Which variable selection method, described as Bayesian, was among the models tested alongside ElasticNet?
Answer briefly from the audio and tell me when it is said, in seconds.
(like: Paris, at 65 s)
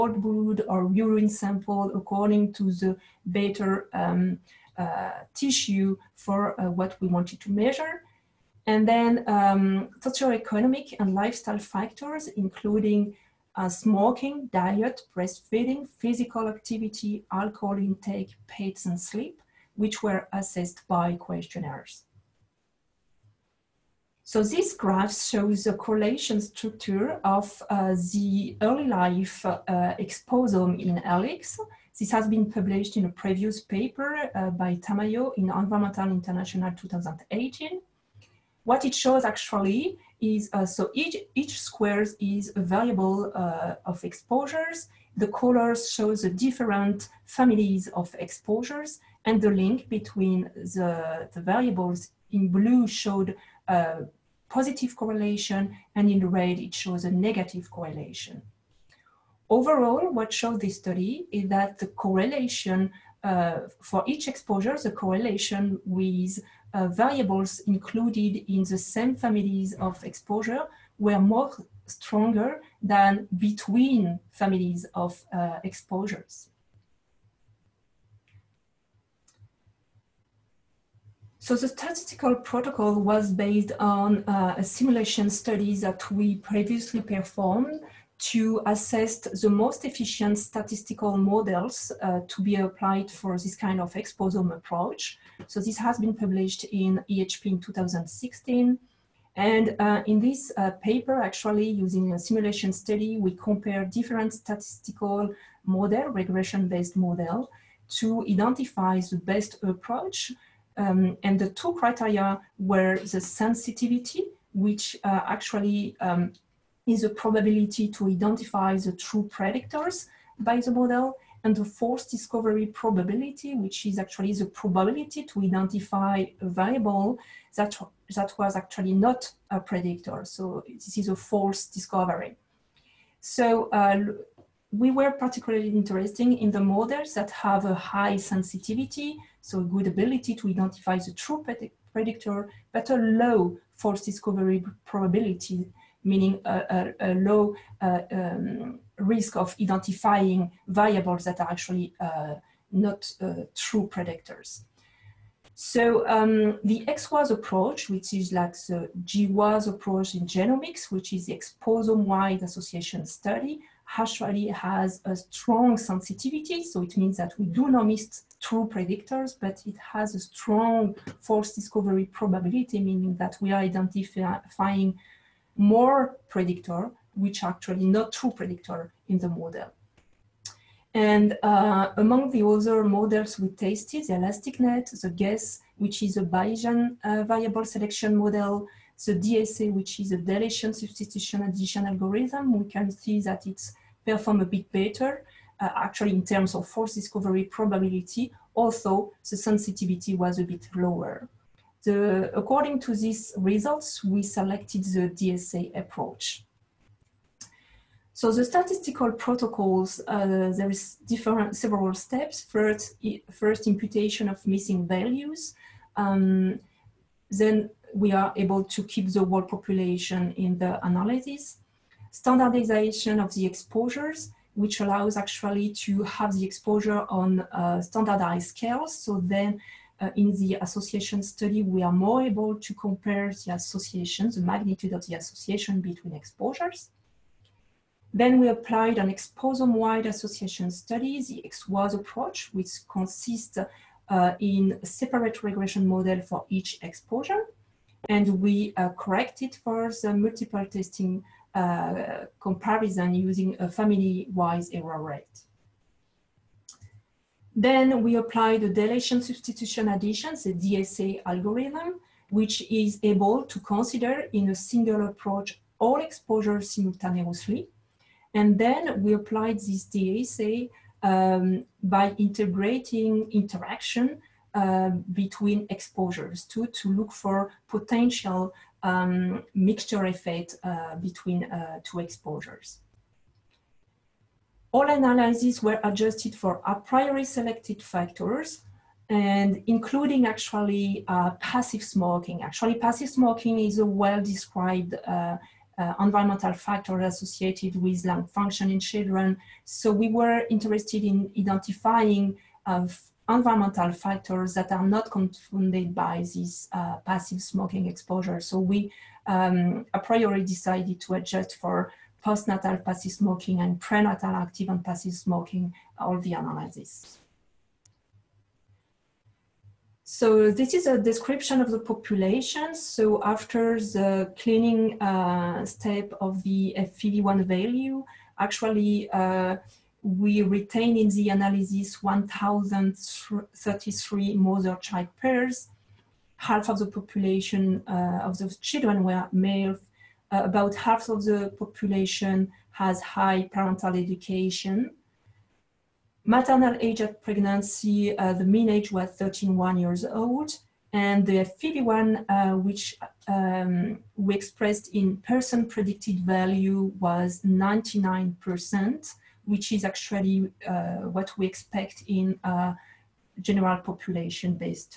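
GUESS, at 185 s.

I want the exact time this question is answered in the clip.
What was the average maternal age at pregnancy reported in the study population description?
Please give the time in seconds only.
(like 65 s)
349 s.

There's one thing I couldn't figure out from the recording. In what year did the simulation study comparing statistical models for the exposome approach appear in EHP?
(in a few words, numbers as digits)
2016.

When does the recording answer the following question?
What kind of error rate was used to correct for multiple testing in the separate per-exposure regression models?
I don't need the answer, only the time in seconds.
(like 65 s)
253 s.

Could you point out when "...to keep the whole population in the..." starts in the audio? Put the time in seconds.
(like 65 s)
218 s.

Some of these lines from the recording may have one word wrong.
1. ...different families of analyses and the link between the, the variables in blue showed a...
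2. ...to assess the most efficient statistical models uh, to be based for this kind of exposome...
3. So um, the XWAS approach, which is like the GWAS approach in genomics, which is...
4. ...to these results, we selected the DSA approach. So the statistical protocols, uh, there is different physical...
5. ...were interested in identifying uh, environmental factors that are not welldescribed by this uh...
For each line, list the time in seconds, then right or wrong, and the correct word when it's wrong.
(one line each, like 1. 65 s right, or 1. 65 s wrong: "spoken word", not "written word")
1. 46 s wrong: "exposures", not "analyses"
2. 88 s wrong: "applied", not "based"
3. 155 s right
4. 202 s wrong: "several", not "physical"
5. 300 s wrong: "confounded", not "welldescribed".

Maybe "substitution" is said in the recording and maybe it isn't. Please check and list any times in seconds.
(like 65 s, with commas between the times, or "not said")
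190 s, 259 s.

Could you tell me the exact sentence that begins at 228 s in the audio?
So then uh, in the association study, we are more able to compare the associations, the magnitude of the association between exposures.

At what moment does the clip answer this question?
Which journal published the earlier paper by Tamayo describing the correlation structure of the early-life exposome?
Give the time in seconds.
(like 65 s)
35 s.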